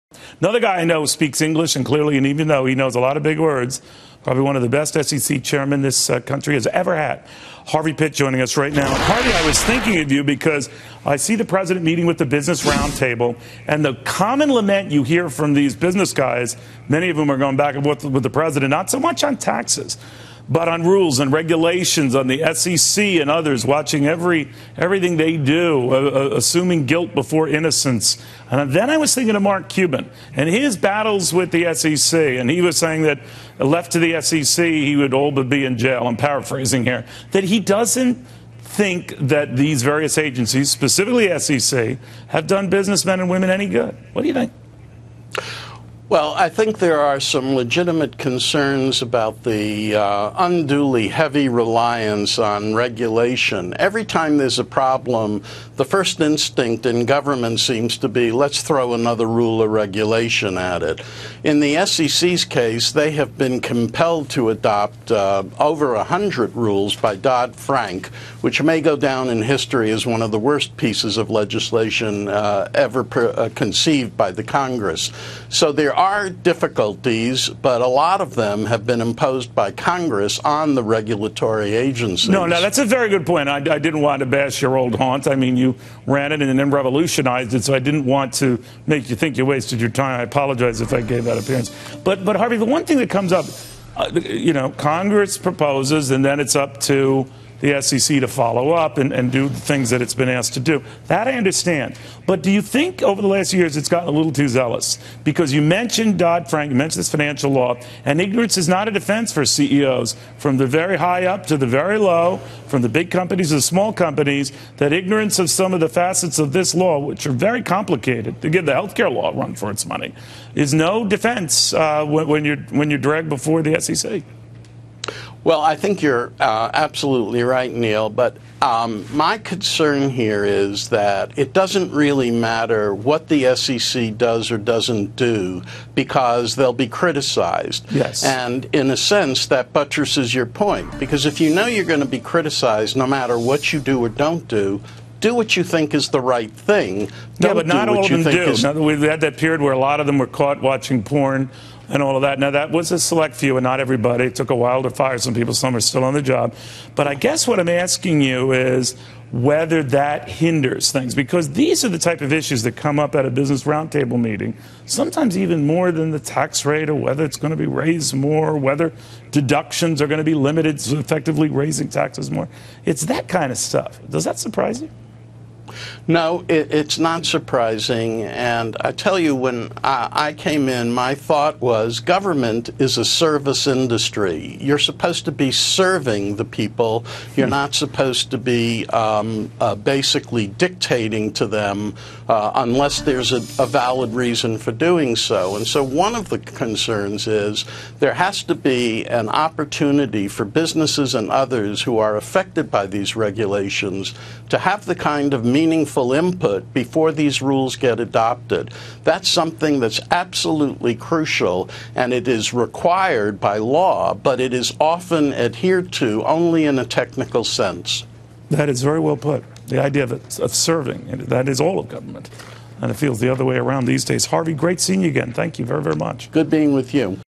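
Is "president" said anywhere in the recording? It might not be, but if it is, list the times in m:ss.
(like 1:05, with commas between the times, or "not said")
0:11, 0:18.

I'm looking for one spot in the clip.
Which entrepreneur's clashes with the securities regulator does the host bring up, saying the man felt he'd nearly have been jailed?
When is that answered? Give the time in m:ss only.
0:29.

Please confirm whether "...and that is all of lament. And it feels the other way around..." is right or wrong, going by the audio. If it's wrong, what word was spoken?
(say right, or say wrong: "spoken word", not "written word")
wrong: "government", not "lament".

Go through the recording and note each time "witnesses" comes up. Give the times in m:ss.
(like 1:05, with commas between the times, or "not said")
not said.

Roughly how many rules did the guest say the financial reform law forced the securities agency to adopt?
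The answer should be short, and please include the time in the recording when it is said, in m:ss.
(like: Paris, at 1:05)
over 100, at 1:05.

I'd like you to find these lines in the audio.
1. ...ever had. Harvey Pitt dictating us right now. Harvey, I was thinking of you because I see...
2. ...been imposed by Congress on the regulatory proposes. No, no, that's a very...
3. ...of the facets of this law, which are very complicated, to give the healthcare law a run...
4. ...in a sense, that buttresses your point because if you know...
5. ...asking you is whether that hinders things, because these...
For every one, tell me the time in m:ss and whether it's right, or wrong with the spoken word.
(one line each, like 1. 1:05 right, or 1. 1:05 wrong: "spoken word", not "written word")
1. 0:06 wrong: "joining", not "dictating"
2. 1:18 wrong: "agencies", not "proposes"
3. 1:55 right
4. 2:18 right
5. 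2:37 right.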